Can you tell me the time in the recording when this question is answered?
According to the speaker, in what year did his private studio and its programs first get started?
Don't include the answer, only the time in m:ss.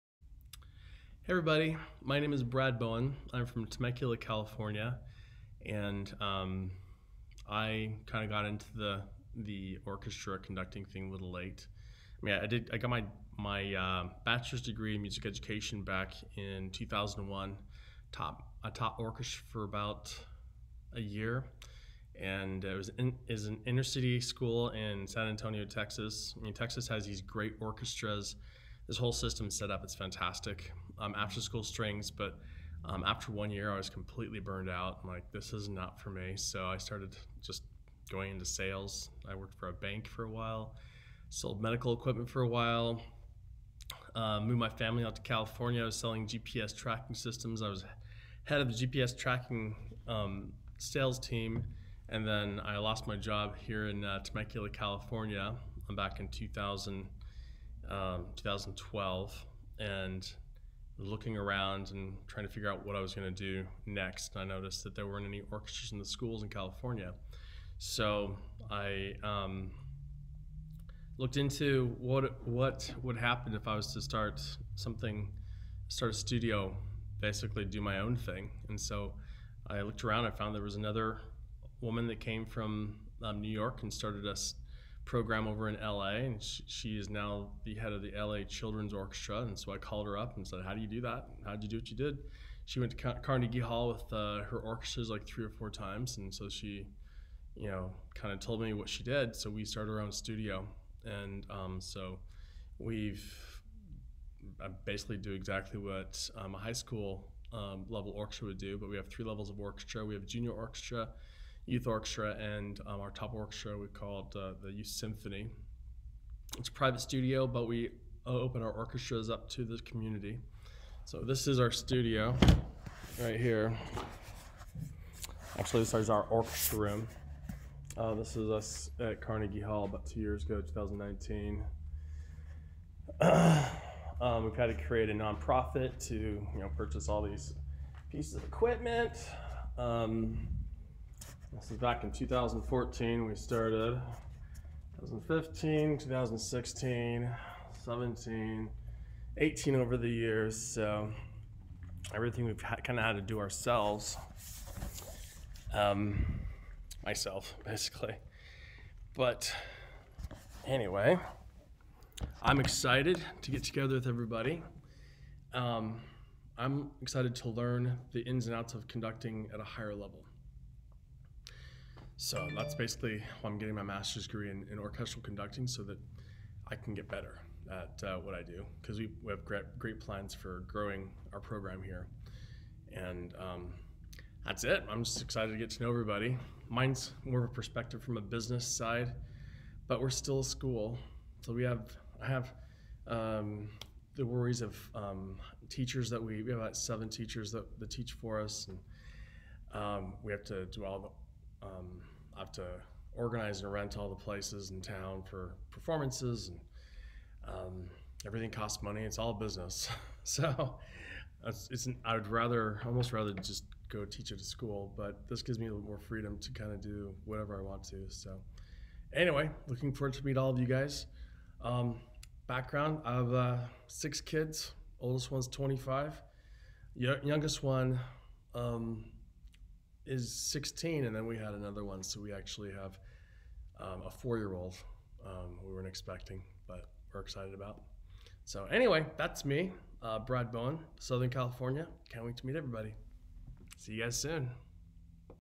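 2:22.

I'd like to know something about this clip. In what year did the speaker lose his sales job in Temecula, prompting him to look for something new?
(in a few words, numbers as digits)
2012.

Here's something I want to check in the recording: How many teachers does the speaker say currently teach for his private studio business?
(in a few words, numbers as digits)
7.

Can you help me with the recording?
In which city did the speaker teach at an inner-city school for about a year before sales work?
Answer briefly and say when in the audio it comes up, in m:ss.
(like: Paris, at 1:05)
San Antonio, at 0:25.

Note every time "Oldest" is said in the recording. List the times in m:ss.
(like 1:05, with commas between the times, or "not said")
3:44.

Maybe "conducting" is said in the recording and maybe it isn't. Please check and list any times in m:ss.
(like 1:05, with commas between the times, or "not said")
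0:10, 2:48, 2:55.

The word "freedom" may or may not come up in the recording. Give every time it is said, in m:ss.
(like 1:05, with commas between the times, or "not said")
3:35.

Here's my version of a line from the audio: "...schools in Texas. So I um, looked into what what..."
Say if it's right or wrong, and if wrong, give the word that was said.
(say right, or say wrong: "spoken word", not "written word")
wrong: "California", not "Texas".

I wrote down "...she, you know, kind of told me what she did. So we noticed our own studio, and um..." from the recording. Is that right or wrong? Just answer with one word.
wrong.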